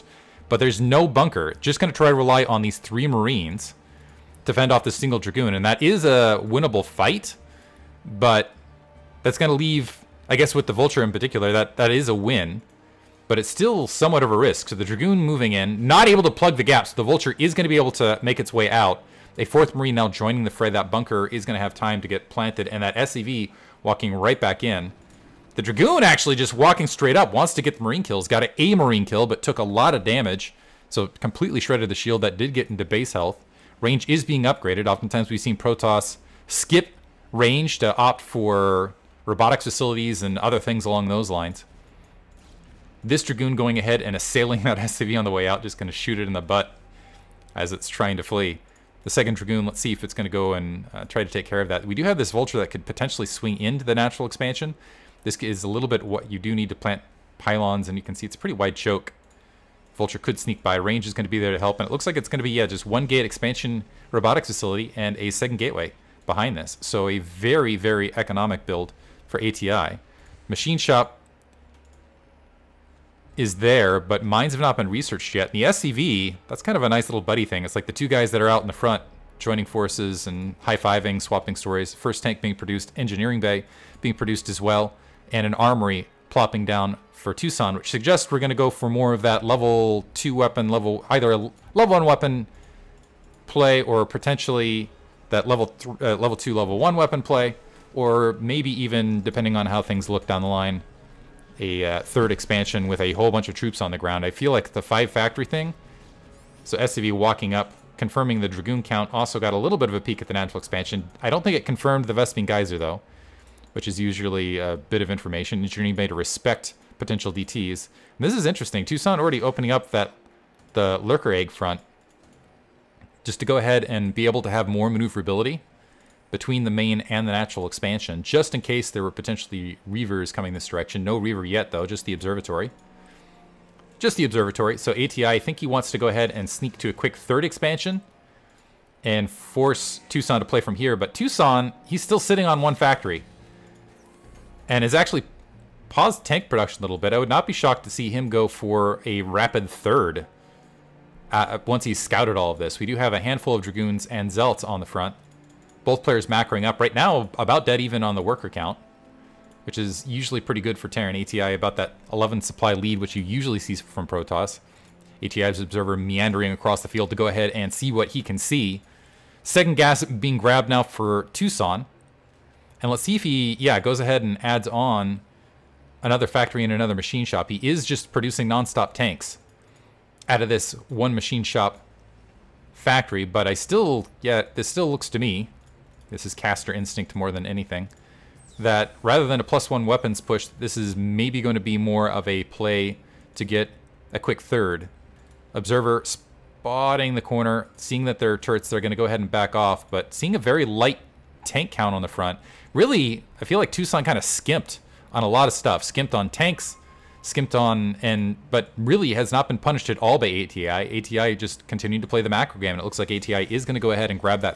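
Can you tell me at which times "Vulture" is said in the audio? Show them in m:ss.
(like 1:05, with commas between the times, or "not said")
0:10, 0:17, 0:52, 0:59.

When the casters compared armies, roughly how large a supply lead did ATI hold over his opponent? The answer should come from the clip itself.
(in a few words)
11 supply.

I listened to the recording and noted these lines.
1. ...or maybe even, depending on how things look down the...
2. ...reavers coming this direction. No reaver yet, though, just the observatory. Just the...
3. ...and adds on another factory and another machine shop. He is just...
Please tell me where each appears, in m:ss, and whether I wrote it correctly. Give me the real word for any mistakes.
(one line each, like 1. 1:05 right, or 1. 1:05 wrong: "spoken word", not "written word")
1. 1:37 right
2. 2:09 right
3. 2:54 right.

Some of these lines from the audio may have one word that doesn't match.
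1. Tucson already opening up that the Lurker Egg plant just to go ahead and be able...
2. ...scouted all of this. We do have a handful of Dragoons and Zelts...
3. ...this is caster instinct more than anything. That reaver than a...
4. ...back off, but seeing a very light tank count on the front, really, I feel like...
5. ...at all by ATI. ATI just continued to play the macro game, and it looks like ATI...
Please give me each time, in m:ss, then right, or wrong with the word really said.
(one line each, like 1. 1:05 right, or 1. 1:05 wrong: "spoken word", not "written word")
1. 1:58 wrong: "front", not "plant"
2. 2:32 right
3. 3:06 wrong: "rather", not "reaver"
4. 3:19 right
5. 3:29 right.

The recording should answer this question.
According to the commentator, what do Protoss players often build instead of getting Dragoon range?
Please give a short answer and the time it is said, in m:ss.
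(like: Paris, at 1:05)
robotics facilities, at 0:39.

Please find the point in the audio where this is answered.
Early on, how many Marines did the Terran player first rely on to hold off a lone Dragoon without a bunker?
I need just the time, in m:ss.
0:02.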